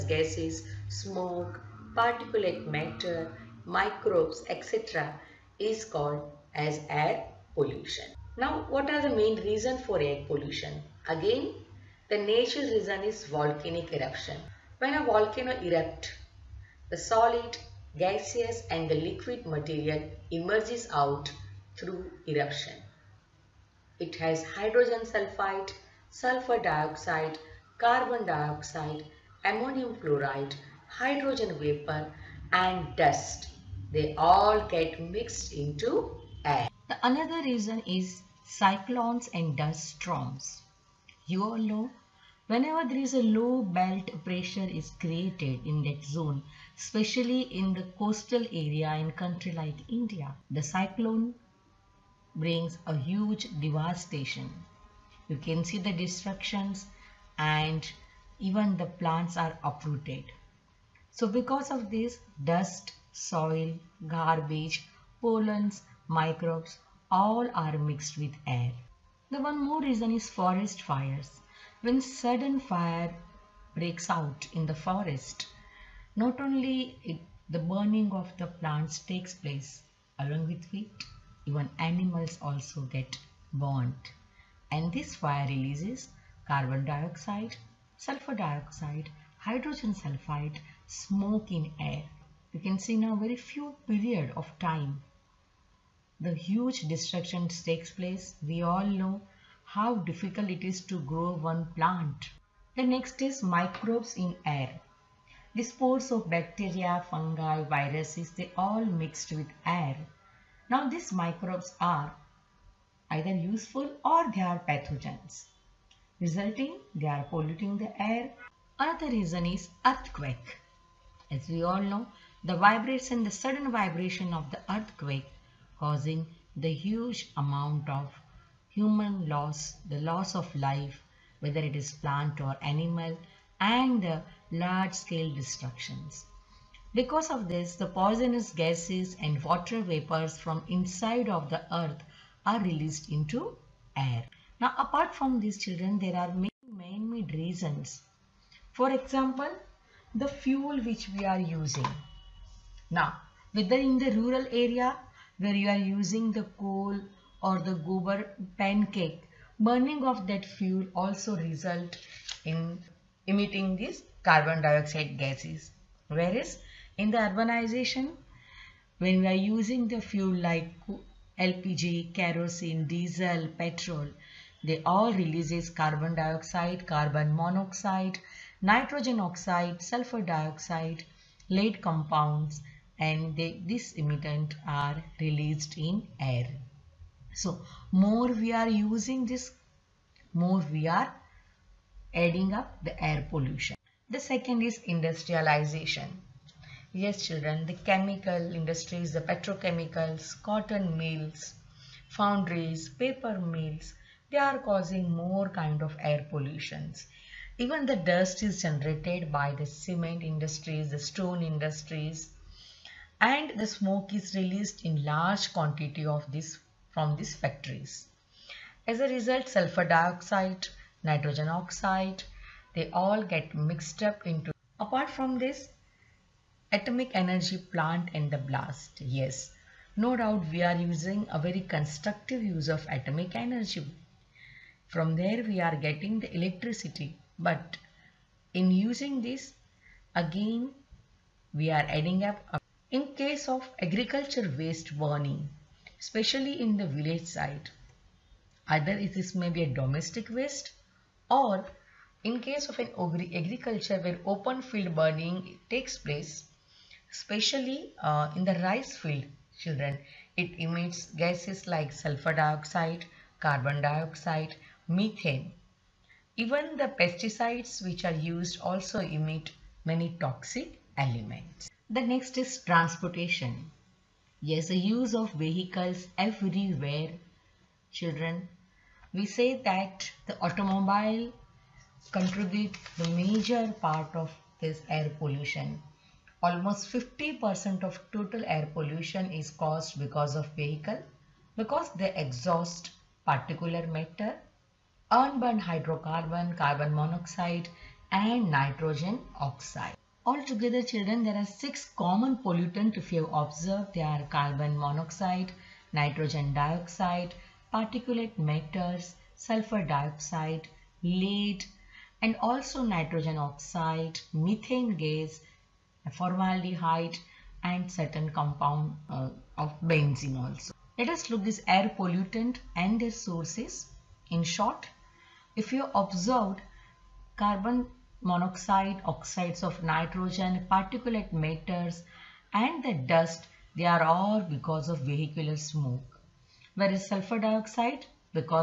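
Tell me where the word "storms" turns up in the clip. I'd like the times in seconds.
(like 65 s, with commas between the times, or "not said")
39 s.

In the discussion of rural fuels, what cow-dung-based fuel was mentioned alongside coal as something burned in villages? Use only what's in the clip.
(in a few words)
Gobar pancake.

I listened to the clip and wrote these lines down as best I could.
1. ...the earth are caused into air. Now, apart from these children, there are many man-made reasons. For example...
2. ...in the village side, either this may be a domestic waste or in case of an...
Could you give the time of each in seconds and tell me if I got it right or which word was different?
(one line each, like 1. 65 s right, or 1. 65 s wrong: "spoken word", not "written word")
1. 141 s wrong: "released", not "caused"
2. 246 s right.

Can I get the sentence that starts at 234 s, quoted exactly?
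From there we are getting the electricity but in using this, again, we are adding up.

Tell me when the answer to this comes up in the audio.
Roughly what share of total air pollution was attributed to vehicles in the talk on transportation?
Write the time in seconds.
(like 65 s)
286 s.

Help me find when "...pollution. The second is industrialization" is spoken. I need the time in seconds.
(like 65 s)
193 s.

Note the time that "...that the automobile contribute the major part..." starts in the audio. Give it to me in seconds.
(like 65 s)
279 s.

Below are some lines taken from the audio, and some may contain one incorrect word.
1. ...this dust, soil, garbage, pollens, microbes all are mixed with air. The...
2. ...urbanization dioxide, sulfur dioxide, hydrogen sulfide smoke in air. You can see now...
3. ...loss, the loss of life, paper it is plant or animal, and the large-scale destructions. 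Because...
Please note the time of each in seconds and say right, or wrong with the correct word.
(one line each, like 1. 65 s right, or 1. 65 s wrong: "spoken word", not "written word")
1. 61 s right
2. 86 s wrong: "carbon", not "urbanization"
3. 129 s wrong: "whether", not "paper".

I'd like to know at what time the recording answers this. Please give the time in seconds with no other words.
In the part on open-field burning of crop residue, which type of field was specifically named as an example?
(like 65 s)
258 s.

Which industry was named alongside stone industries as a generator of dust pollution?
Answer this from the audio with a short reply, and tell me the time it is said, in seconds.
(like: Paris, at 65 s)
Cement industries, at 209 s.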